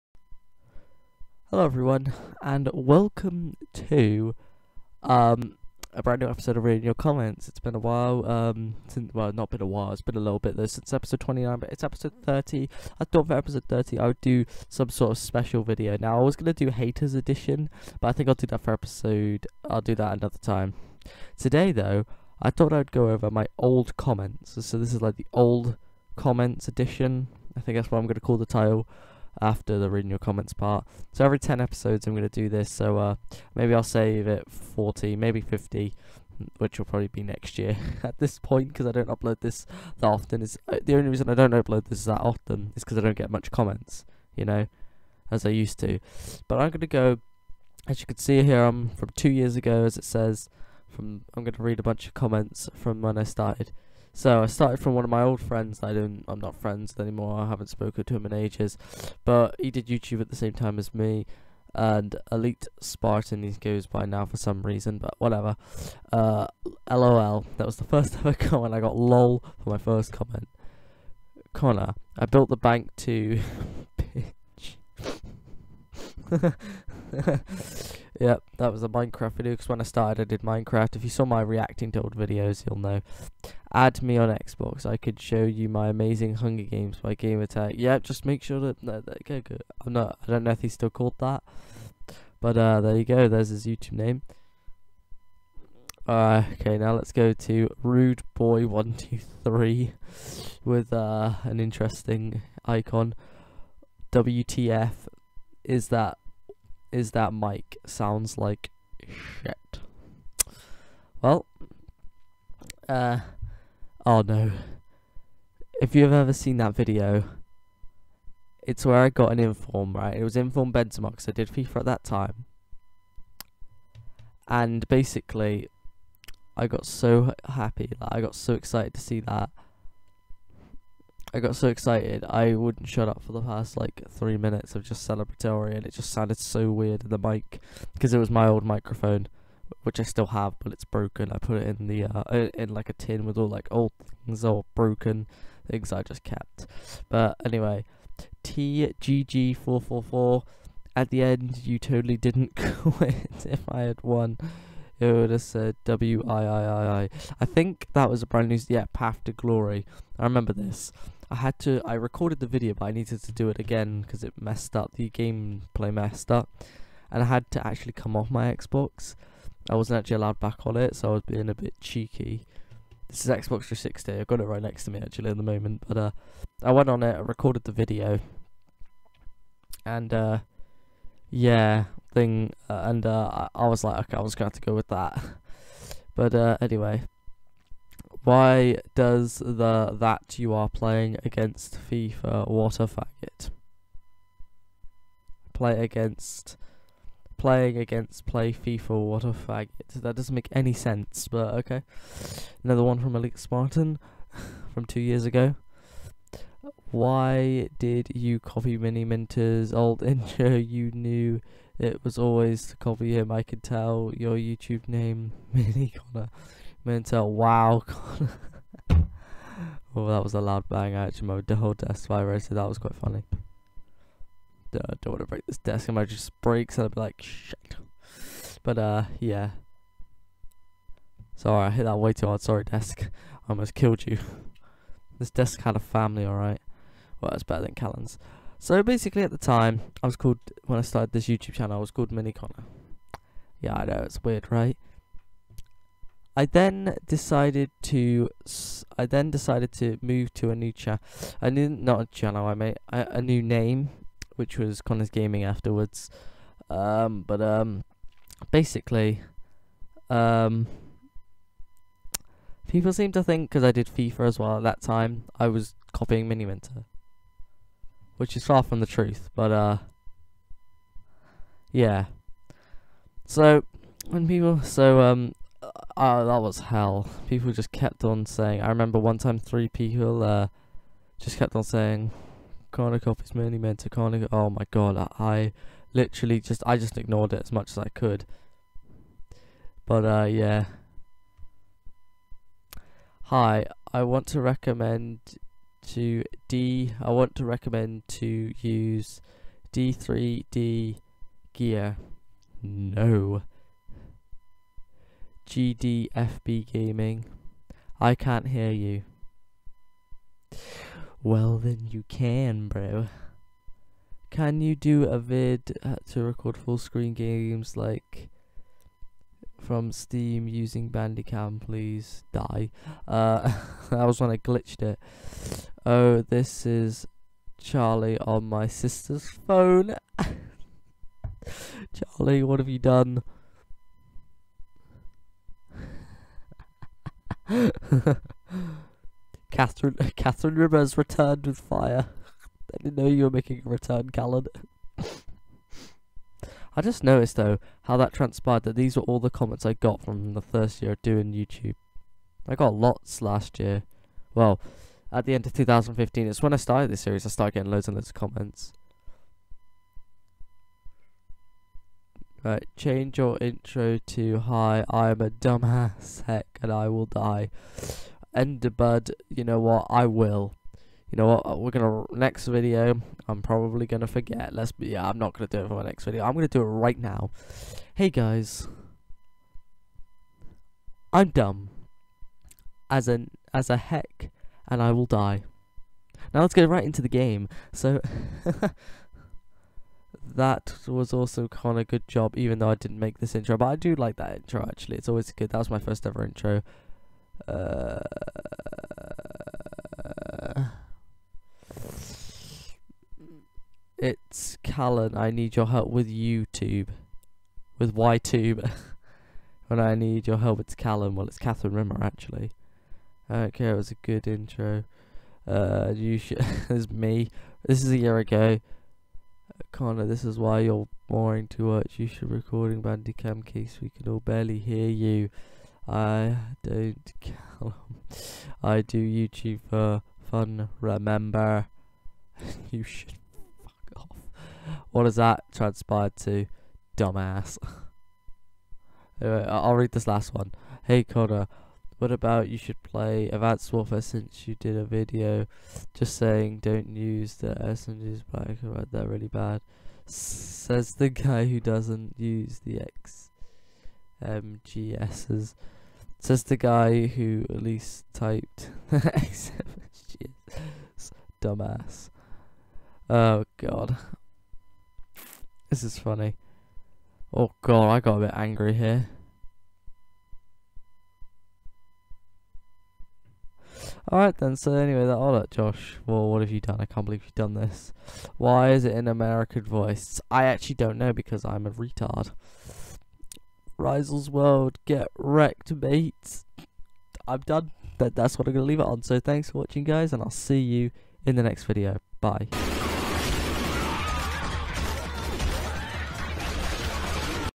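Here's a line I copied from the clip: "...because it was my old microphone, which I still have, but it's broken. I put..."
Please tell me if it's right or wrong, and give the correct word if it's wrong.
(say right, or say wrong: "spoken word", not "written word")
right.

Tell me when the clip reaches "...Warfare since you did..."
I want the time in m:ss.
7:23.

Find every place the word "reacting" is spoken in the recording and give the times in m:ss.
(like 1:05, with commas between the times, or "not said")
1:21.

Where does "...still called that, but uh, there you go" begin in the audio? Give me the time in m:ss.
1:30.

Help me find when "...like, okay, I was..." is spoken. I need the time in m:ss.
3:03.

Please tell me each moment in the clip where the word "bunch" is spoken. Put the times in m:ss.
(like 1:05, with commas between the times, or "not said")
0:51.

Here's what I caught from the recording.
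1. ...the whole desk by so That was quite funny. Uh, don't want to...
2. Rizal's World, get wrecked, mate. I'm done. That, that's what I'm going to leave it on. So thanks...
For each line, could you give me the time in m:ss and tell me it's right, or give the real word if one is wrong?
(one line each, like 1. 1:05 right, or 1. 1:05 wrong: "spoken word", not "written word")
1. 3:41 right
2. 8:03 right.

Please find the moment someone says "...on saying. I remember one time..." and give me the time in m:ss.
4:38.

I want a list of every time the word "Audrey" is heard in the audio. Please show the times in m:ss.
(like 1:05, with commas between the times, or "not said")
not said.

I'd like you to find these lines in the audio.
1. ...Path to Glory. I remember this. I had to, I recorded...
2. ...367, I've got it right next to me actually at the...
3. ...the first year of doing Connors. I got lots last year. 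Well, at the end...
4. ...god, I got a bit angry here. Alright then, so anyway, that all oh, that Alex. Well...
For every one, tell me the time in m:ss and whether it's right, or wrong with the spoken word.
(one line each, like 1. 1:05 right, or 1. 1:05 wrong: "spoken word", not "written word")
1. 2:38 right
2. 2:53 wrong: "360", not "367"
3. 5:50 wrong: "YouTube", not "Connors"
4. 7:47 wrong: "Josh", not "Alex".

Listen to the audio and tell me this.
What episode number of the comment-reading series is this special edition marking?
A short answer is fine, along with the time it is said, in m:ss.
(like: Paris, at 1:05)
30, at 0:11.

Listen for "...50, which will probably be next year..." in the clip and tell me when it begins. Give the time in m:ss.
0:35.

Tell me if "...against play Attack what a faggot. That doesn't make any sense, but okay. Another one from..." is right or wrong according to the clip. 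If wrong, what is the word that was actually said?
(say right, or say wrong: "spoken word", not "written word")
wrong: "FIFA", not "Attack".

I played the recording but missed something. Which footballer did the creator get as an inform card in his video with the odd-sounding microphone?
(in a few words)
Benzema.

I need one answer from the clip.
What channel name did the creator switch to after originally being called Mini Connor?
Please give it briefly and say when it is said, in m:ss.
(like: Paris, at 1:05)
Connors Gaming, at 4:14.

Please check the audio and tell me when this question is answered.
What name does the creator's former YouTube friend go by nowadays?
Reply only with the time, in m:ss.
1:02.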